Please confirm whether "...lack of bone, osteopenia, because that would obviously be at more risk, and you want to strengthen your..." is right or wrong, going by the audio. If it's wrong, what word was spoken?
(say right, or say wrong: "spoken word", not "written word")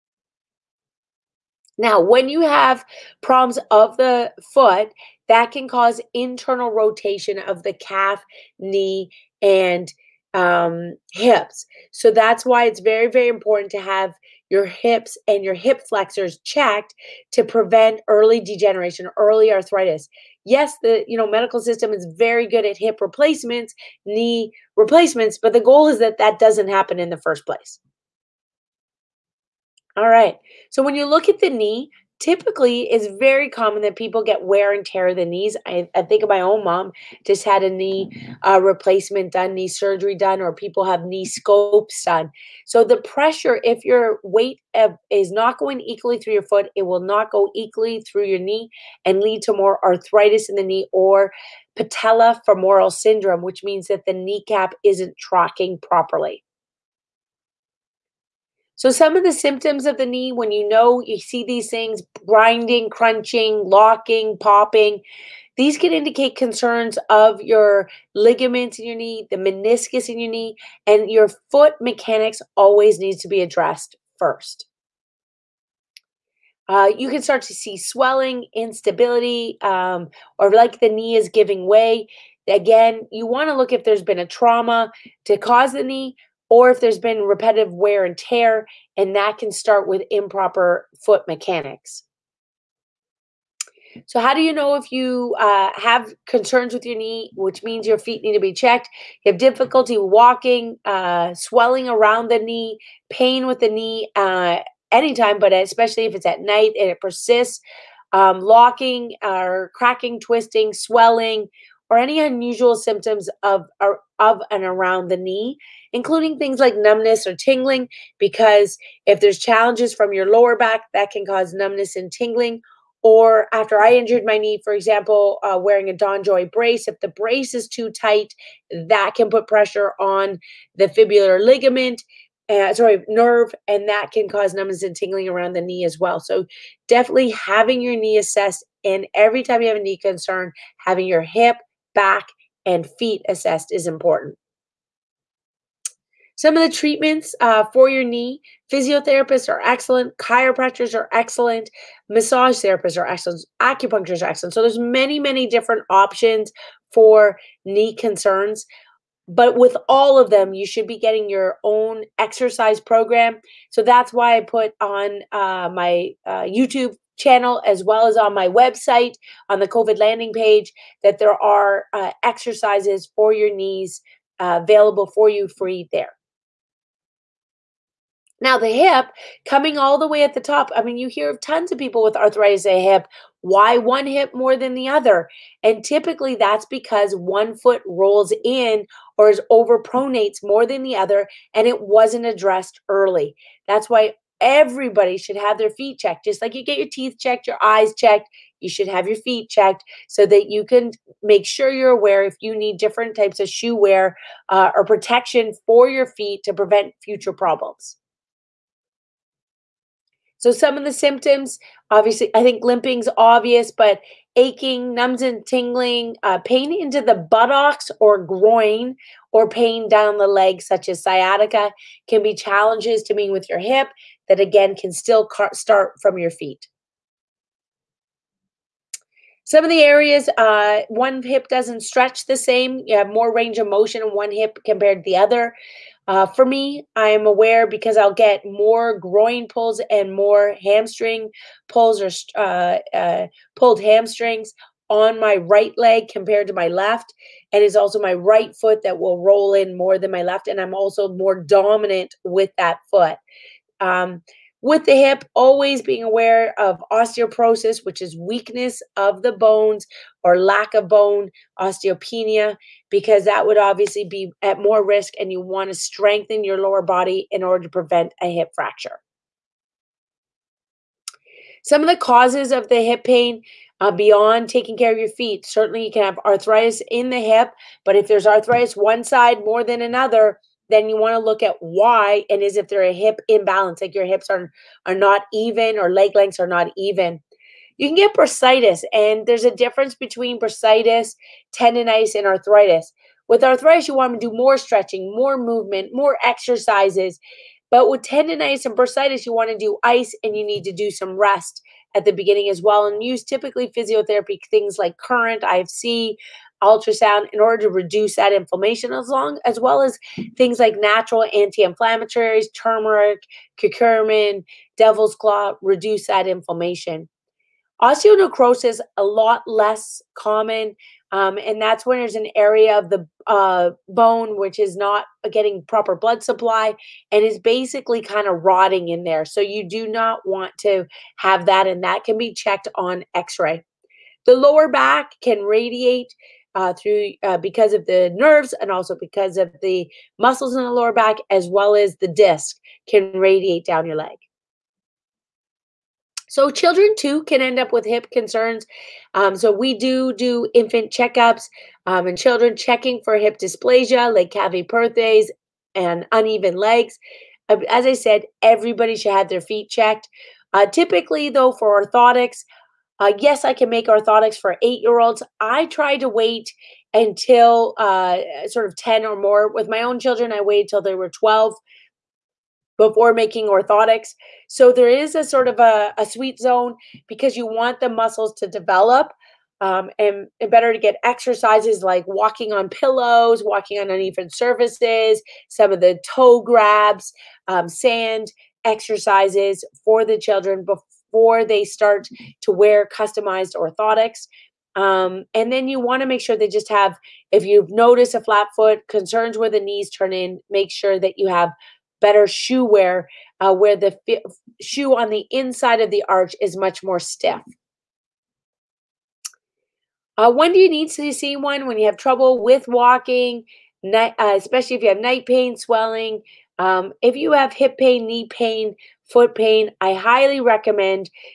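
right.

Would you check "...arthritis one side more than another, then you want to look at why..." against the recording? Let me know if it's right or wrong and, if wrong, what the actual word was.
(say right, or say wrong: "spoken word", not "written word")
right.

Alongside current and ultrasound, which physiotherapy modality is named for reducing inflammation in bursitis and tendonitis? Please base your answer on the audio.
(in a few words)
IFC.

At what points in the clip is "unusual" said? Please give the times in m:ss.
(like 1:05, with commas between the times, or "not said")
1:52.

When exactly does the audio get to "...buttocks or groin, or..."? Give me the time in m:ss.
3:37.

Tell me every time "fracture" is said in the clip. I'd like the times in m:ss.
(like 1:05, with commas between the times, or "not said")
4:28.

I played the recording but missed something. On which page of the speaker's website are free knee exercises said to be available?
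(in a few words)
the COVID landing page.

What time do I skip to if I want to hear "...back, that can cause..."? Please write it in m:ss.
2:00.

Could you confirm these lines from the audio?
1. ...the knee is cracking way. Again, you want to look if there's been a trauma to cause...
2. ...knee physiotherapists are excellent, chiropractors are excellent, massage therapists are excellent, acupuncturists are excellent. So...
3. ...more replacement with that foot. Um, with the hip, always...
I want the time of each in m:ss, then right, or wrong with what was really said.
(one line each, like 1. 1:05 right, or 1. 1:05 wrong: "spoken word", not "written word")
1. 1:20 wrong: "giving", not "cracking"
2. 2:28 right
3. 4:11 wrong: "dominant", not "replacement".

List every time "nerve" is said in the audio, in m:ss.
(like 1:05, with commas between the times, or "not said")
2:13, 5:38.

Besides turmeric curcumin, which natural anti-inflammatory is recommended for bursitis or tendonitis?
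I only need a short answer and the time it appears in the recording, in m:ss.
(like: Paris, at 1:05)
devil's claw, at 5:14.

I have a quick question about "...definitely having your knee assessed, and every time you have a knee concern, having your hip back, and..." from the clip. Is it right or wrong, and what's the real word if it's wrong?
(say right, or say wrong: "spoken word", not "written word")
right.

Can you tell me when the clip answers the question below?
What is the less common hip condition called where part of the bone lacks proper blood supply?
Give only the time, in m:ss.
5:17.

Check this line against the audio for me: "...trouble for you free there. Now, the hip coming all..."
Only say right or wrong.
wrong.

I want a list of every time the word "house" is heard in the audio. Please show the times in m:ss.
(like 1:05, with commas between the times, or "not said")
not said.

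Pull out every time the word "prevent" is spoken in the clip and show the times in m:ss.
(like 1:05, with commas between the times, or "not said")
0:17, 3:26, 4:27.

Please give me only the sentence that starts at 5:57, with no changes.
Uh, as I said, everybody should have their feet checked.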